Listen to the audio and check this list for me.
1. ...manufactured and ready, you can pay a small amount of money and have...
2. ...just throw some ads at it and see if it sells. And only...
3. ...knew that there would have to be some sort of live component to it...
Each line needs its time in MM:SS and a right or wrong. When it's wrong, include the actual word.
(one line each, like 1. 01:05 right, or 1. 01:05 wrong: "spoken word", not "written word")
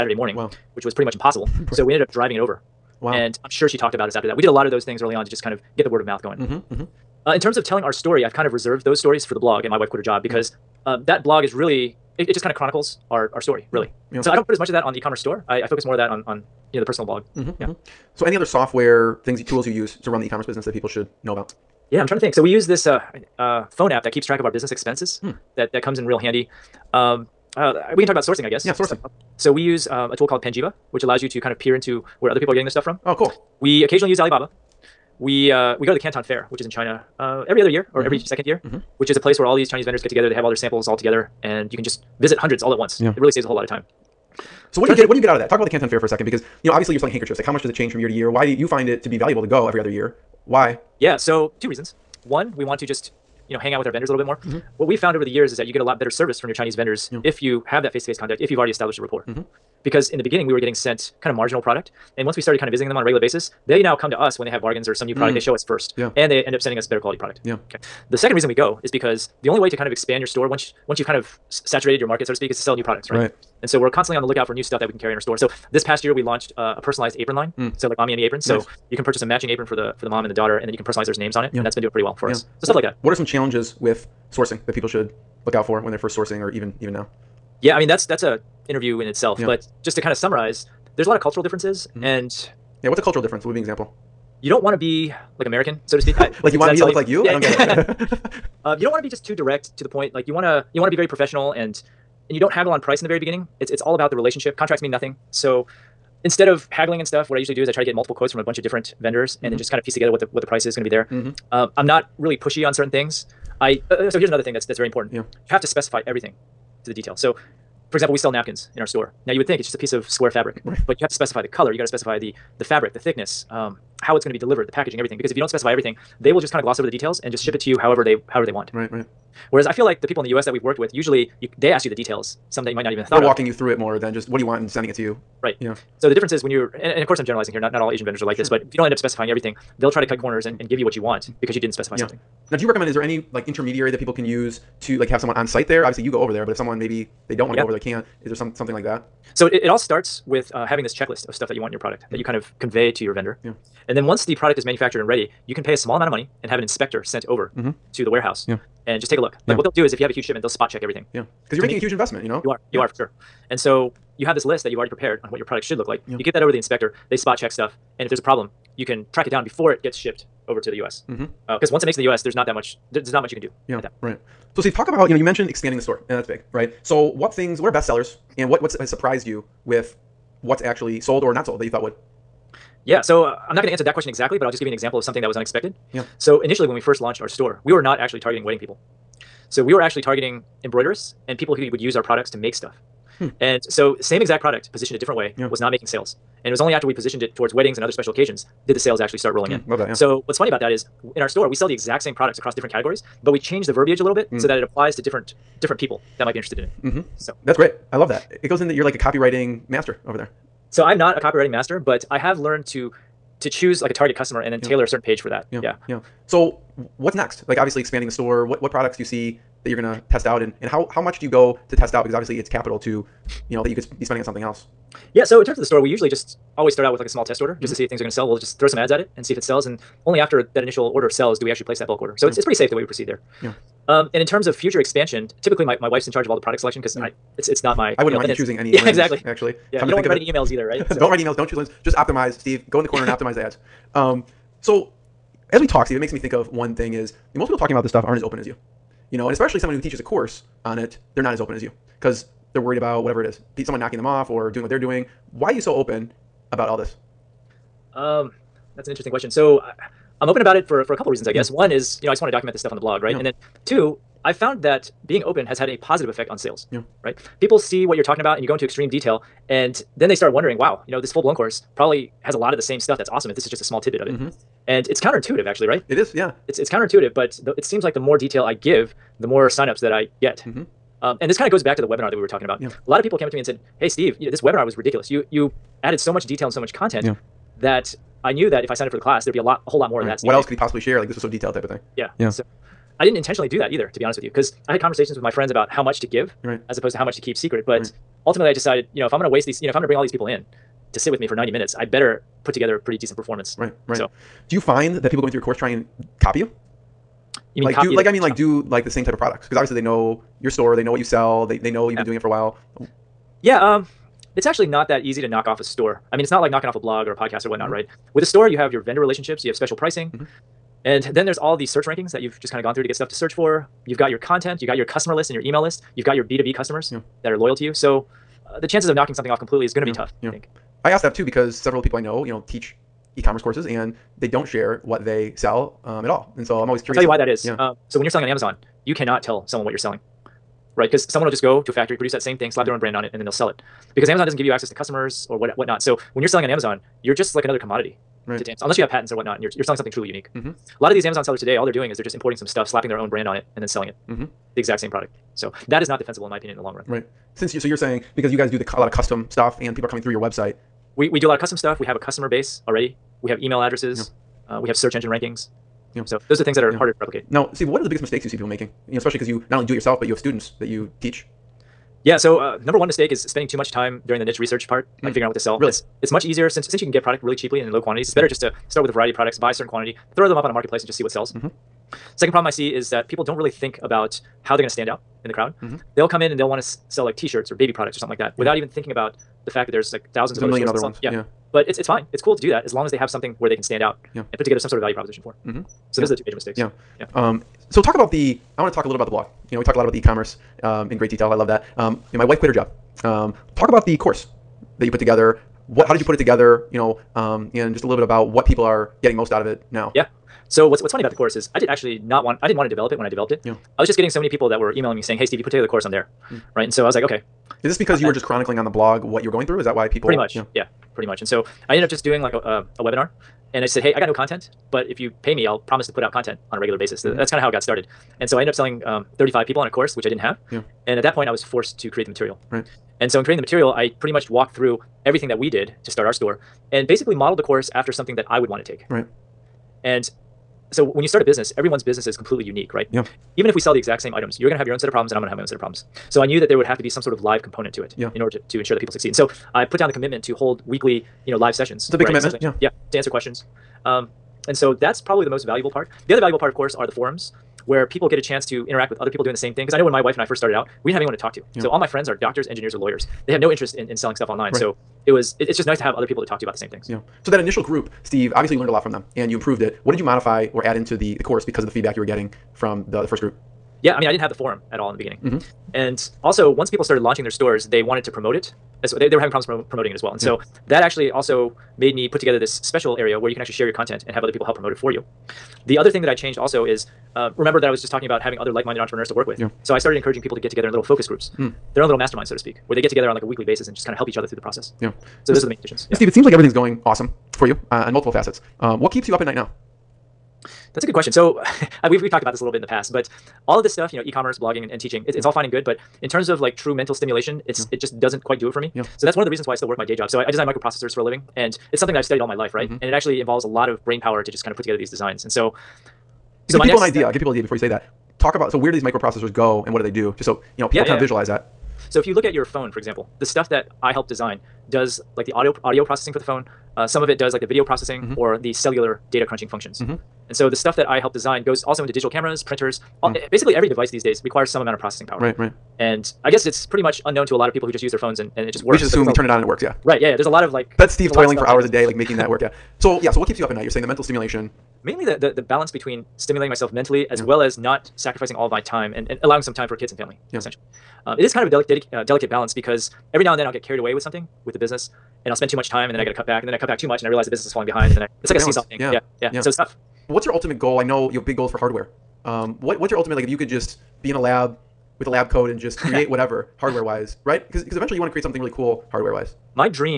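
1. 02:34 right
2. 03:48 right
3. 07:26 right.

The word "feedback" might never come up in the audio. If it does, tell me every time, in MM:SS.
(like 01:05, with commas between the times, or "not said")
07:51.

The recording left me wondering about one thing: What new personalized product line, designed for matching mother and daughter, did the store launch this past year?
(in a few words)
aprons.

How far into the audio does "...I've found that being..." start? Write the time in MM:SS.
04:24.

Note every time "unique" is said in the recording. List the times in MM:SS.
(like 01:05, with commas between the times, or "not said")
05:50, 07:22.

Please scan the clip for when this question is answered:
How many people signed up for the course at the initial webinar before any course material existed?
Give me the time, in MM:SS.
07:09.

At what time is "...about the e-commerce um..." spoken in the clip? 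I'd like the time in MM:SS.
06:39.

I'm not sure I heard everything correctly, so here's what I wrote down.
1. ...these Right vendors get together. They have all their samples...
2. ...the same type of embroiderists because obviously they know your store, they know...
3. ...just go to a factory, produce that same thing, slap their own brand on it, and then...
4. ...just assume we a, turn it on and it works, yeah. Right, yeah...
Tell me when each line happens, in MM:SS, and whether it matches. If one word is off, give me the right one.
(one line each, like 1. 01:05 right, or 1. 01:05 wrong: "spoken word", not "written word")
1. 00:39 wrong: "Chinese", not "Right"
2. 05:08 wrong: "products", not "embroiderists"
3. 05:41 right
4. 08:58 right.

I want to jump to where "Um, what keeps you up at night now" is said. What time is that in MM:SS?
08:18.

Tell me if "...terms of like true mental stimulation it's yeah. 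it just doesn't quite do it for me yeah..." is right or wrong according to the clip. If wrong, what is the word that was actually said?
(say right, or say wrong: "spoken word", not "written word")
right.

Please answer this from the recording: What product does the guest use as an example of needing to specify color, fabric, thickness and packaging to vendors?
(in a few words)
napkins.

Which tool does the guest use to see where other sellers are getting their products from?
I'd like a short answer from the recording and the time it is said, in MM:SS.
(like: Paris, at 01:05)
Panjiva, at 00:30.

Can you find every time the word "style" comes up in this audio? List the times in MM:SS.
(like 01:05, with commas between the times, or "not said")
not said.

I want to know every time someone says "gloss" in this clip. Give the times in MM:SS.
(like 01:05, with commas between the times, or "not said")
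02:06.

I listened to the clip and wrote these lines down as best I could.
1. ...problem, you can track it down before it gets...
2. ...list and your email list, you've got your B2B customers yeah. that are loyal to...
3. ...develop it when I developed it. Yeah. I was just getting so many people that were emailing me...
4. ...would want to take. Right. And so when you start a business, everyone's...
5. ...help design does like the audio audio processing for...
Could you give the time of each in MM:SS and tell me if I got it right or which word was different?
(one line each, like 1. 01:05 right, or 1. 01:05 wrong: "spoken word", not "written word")
1. 02:48 right
2. 05:25 right
3. 06:52 right
4. 07:18 right
5. 08:43 right.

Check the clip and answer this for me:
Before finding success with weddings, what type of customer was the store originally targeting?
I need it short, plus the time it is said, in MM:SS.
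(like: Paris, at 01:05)
embroiderists, at 03:10.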